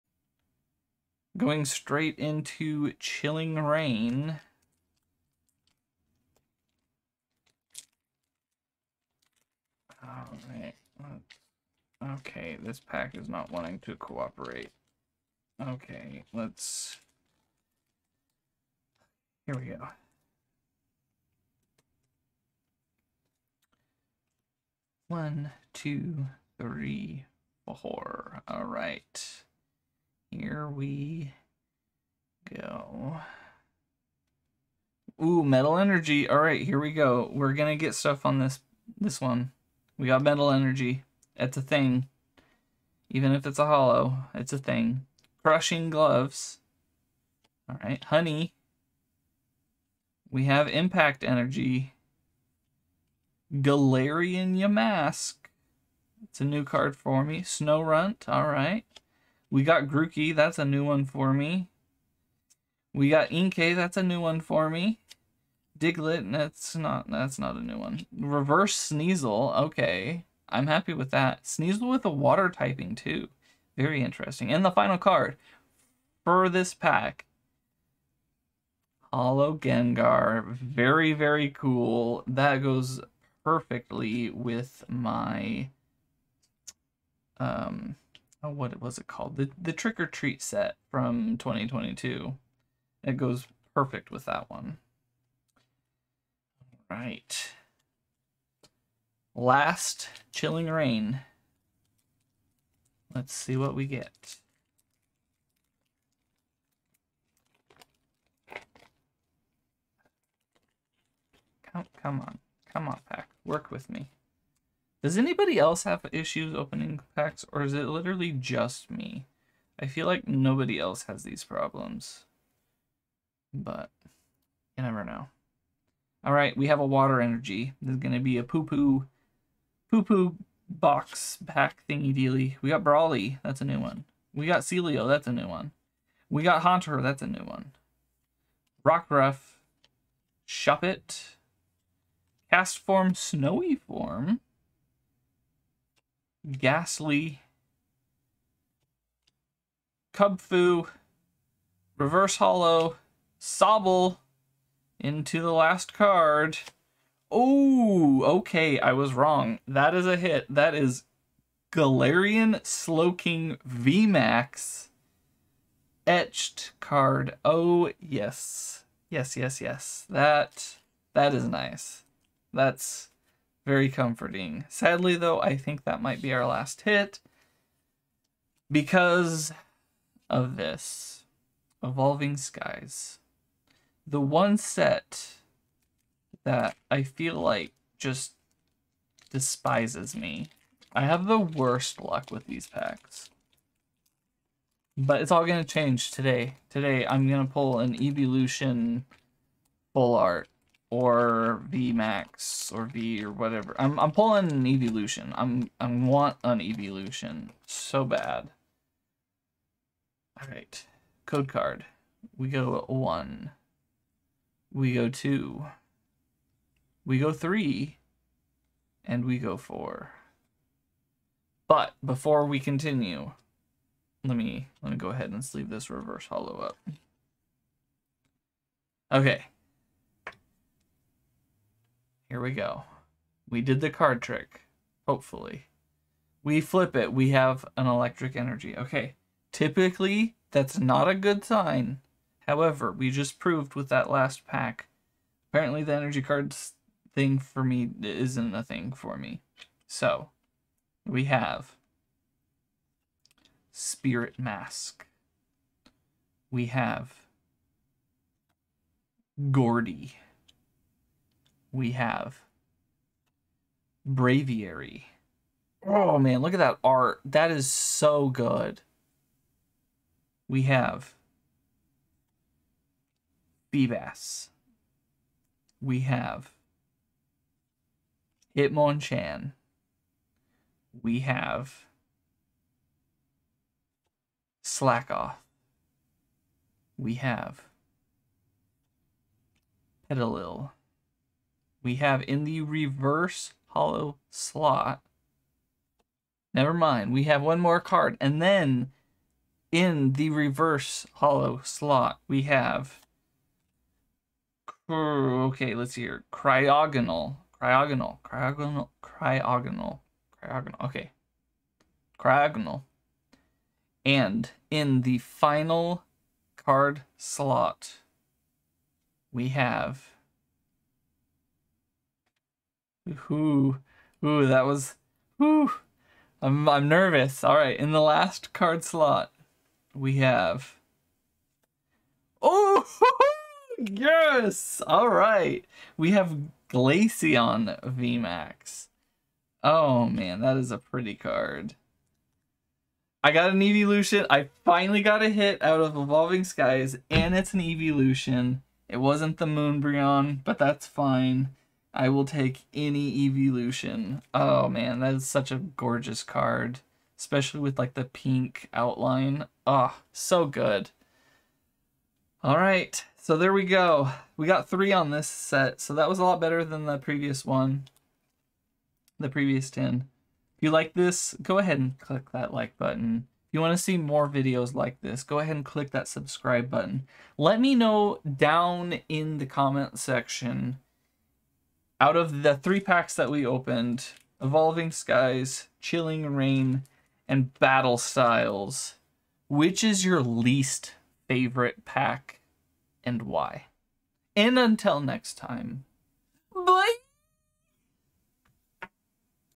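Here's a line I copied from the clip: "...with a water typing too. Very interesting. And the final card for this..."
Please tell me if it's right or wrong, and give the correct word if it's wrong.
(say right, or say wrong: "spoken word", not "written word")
right.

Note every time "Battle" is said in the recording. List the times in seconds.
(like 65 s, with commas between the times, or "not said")
387 s.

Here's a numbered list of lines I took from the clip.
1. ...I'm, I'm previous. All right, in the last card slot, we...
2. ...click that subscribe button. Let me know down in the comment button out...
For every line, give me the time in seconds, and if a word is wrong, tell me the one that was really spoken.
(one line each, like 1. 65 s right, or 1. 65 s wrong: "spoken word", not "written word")
1. 326 s wrong: "nervous", not "previous"
2. 375 s wrong: "section", not "button".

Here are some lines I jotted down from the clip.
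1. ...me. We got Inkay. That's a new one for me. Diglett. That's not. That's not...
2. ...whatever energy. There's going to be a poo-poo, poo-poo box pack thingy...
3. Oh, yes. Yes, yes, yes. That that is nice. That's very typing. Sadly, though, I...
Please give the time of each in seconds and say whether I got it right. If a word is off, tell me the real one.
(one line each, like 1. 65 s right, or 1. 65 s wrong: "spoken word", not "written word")
1. 61 s right
2. 126 s wrong: "water", not "whatever"
3. 167 s wrong: "comforting", not "typing".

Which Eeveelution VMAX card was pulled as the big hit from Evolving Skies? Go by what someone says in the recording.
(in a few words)
Glaceon VMAX.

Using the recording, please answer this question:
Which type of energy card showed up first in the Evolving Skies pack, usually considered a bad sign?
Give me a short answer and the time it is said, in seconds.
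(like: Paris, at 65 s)
Electric energy, at 237 s.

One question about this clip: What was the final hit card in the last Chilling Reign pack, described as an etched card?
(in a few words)
Galarian Slowking VMAX.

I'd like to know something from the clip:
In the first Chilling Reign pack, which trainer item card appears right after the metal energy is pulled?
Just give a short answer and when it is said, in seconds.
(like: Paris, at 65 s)
Crushing Gloves, at 45 s.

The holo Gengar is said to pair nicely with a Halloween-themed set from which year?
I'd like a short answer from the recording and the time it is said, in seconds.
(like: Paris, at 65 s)
2022, at 91 s.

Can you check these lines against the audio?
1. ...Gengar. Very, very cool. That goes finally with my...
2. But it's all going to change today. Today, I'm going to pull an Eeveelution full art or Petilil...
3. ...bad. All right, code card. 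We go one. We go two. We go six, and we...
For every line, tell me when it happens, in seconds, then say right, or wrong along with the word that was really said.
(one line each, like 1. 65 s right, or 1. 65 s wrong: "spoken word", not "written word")
1. 79 s wrong: "perfectly", not "finally"
2. 194 s wrong: "VMAX", not "Petilil"
3. 208 s wrong: "three", not "six".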